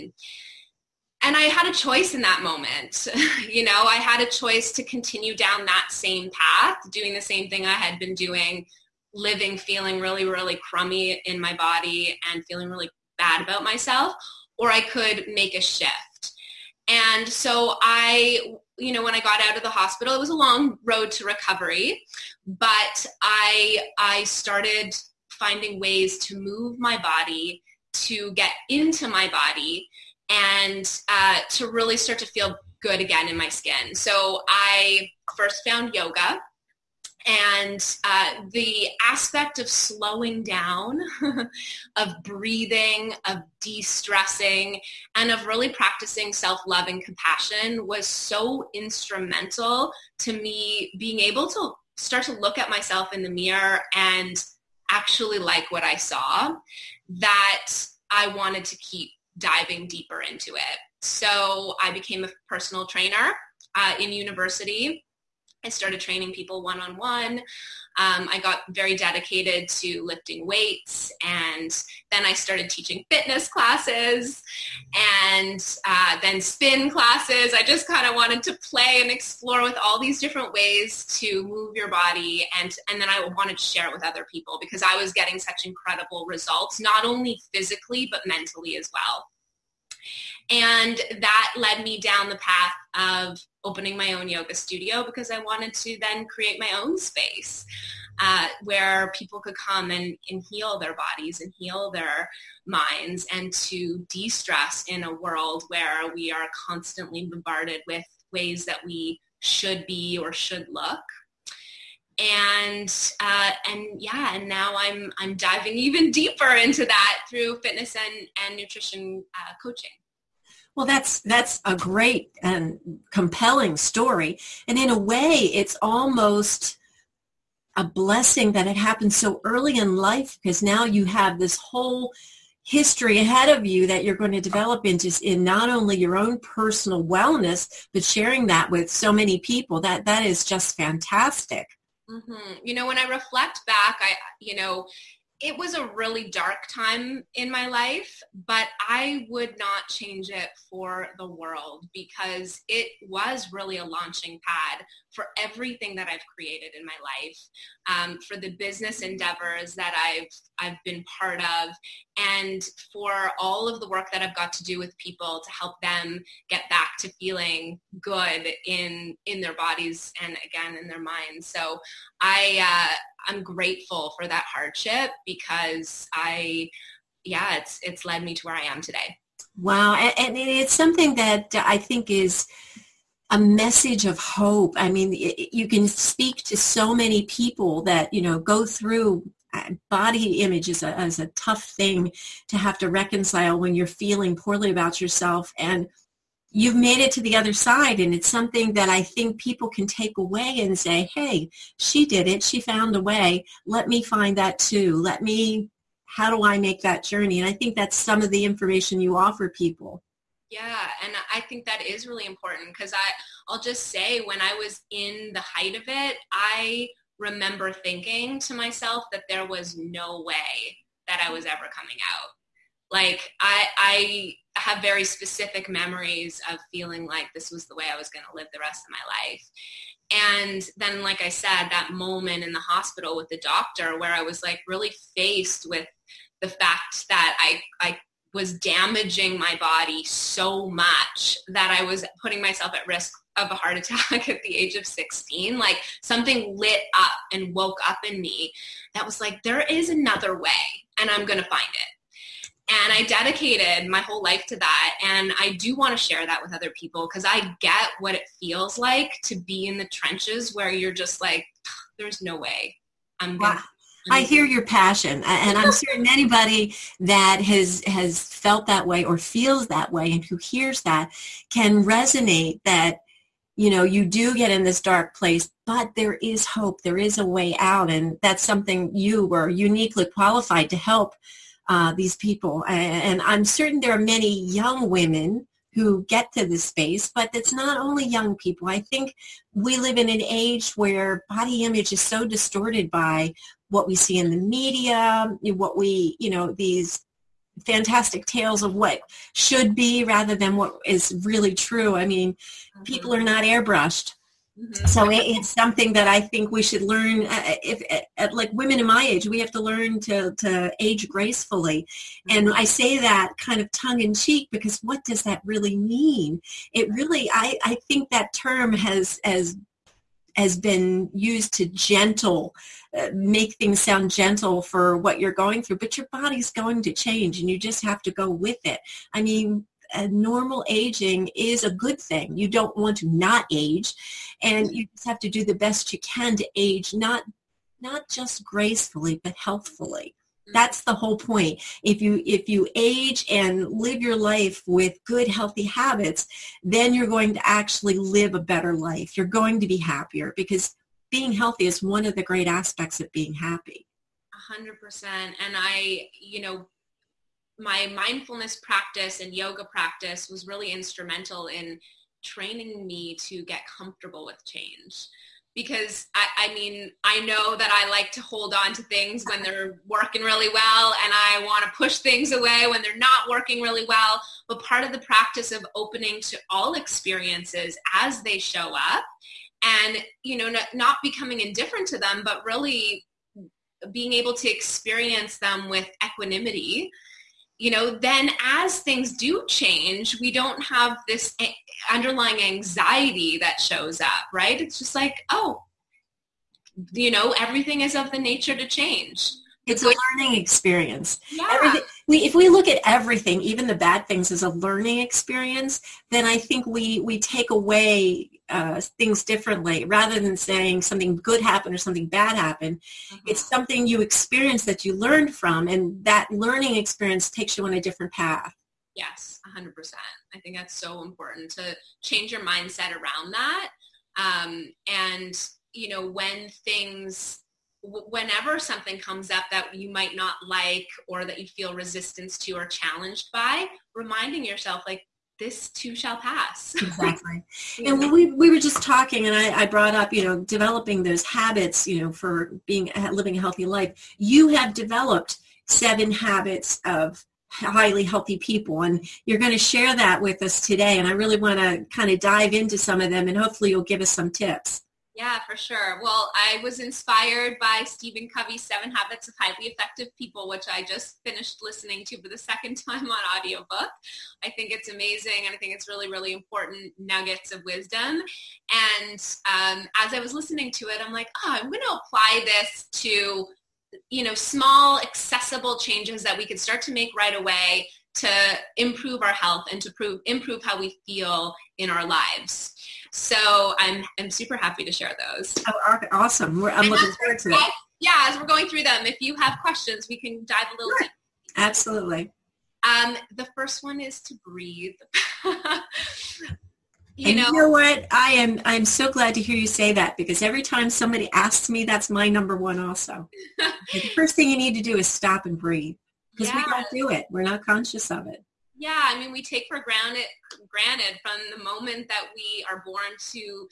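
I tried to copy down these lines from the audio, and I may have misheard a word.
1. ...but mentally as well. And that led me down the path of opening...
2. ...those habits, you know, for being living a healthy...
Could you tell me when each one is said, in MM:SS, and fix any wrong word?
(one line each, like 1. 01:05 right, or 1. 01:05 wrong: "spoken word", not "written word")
1. 01:28 right
2. 07:21 right.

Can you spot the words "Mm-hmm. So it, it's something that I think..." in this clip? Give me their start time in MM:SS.
05:04.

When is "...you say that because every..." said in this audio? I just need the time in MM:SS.
08:19.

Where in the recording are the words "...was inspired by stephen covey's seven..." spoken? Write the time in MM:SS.
07:36.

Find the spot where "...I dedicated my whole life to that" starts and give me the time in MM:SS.
04:12.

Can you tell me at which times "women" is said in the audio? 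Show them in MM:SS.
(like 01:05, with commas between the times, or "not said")
04:44, 05:08.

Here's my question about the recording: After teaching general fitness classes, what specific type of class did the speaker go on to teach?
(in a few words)
spin classes.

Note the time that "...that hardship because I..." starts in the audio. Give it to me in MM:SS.
02:54.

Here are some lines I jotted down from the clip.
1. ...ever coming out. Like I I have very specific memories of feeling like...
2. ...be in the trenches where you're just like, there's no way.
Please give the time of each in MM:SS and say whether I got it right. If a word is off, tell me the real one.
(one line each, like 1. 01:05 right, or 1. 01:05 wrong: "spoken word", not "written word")
1. 03:41 right
2. 04:19 right.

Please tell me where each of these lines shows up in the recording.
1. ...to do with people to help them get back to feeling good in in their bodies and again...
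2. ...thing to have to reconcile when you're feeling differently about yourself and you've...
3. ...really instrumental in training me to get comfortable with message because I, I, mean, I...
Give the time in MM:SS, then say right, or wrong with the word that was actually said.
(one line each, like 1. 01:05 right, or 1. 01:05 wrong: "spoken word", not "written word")
1. 02:44 right
2. 03:11 wrong: "poorly", not "differently"
3. 06:00 wrong: "change", not "message".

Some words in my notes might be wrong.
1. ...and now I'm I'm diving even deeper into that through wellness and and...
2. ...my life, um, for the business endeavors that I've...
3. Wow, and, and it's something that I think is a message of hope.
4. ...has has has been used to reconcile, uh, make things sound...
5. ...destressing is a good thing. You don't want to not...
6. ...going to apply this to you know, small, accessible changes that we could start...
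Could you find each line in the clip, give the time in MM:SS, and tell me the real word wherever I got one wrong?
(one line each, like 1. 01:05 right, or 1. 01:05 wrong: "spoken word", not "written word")
1. 01:54 wrong: "fitness", not "wellness"
2. 02:36 right
3. 02:59 right
4. 05:18 wrong: "gentle", not "reconcile"
5. 05:30 wrong: "aging", not "destressing"
6. 07:51 right.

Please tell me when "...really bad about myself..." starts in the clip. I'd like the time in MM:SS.
00:12.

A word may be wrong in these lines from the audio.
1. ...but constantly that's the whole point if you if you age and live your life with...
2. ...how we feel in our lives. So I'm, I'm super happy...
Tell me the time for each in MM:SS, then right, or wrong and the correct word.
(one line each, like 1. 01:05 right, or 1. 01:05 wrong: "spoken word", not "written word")
1. 05:39 wrong: "healthfully", not "constantly"
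2. 08:00 right.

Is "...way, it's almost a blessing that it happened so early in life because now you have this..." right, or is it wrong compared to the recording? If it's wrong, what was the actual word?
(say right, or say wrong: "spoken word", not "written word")
right.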